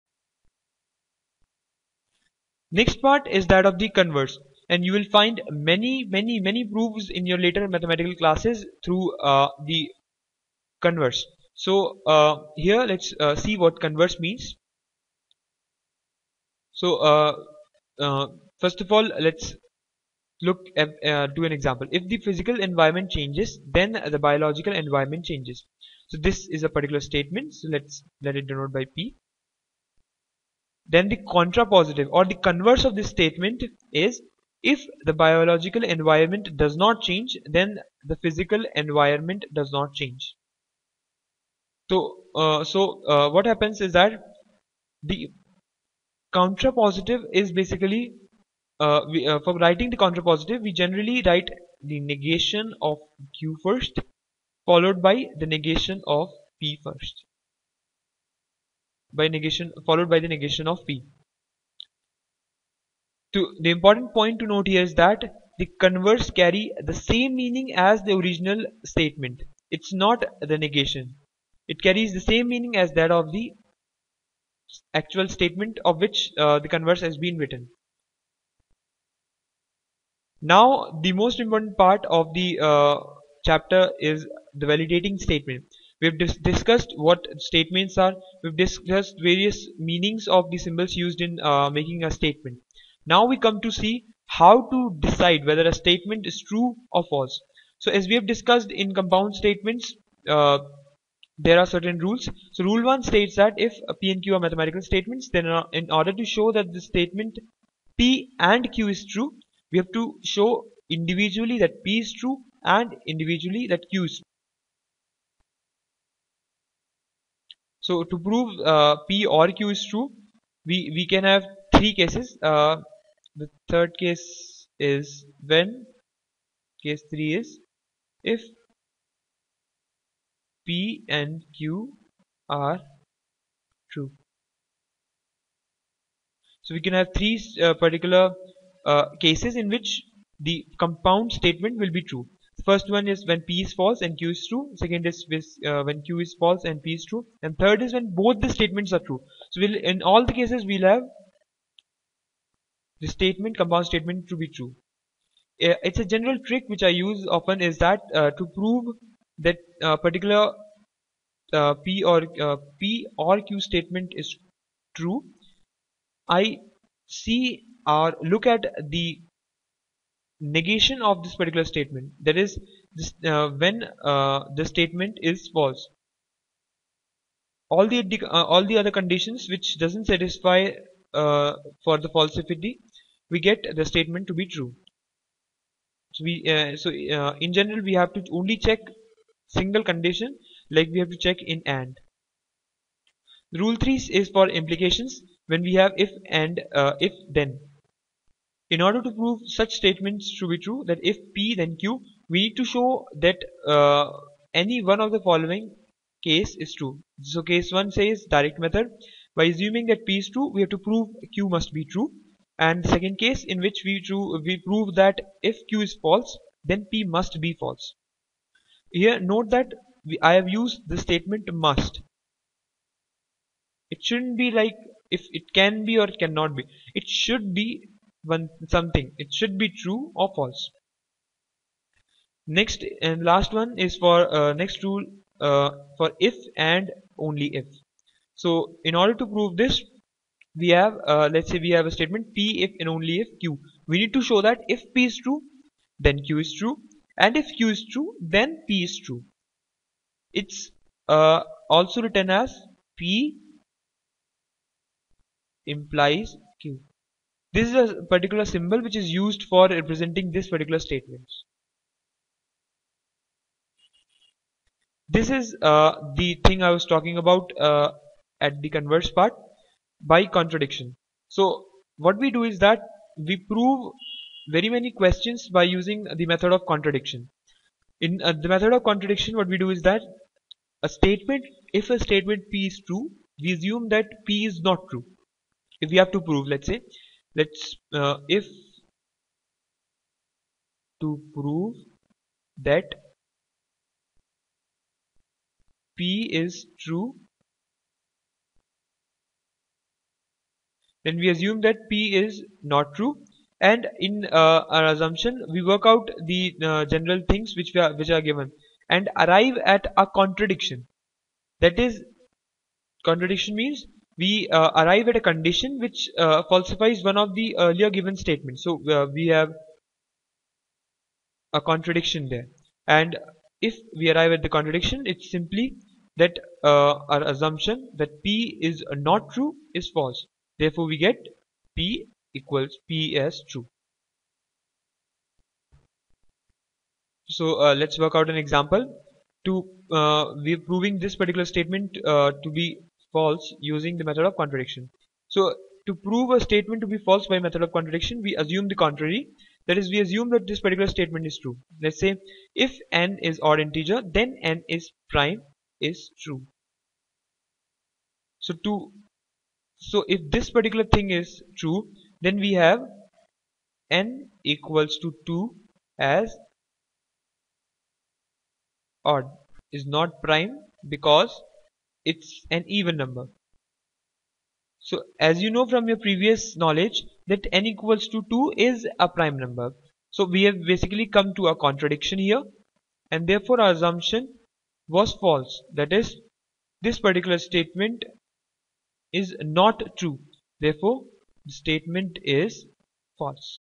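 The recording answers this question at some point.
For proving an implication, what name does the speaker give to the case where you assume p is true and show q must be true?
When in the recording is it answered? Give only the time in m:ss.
3:28.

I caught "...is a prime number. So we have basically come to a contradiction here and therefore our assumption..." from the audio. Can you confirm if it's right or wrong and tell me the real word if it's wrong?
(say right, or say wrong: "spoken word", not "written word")
right.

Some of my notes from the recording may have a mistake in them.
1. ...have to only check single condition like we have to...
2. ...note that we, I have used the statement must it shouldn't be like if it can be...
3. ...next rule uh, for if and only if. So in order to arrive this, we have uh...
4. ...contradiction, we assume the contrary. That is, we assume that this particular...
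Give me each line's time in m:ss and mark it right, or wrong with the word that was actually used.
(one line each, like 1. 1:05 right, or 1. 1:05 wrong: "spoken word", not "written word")
1. 3:07 right
2. 3:39 right
3. 3:54 wrong: "prove", not "arrive"
4. 5:47 right.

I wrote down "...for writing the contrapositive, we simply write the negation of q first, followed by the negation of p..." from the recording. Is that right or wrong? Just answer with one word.
wrong.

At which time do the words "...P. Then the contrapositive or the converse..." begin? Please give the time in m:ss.
0:28.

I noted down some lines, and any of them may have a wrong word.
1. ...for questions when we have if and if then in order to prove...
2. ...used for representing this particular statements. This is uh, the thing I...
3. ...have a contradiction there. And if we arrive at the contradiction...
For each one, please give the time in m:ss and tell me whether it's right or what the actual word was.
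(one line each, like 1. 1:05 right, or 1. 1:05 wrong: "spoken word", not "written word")
1. 3:14 wrong: "implications", not "questions"
2. 4:19 right
3. 5:19 right.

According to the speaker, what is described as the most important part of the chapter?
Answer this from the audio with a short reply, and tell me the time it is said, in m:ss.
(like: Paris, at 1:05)
Validating statement, at 1:24.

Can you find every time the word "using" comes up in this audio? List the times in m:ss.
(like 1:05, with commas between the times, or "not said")
4:35, 5:43.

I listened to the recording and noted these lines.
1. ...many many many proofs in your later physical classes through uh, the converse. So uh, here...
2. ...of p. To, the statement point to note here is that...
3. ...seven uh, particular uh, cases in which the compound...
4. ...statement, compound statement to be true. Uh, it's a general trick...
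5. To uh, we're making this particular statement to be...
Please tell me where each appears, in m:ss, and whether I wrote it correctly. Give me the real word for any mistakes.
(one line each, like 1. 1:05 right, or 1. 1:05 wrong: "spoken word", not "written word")
1. 0:05 wrong: "mathematical", not "physical"
2. 1:00 wrong: "important", not "statement"
3. 2:17 wrong: "three", not "seven"
4. 2:33 right
5. 5:39 wrong: "proving", not "making".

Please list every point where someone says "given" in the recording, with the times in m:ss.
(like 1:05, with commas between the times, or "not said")
5:08, 5:17.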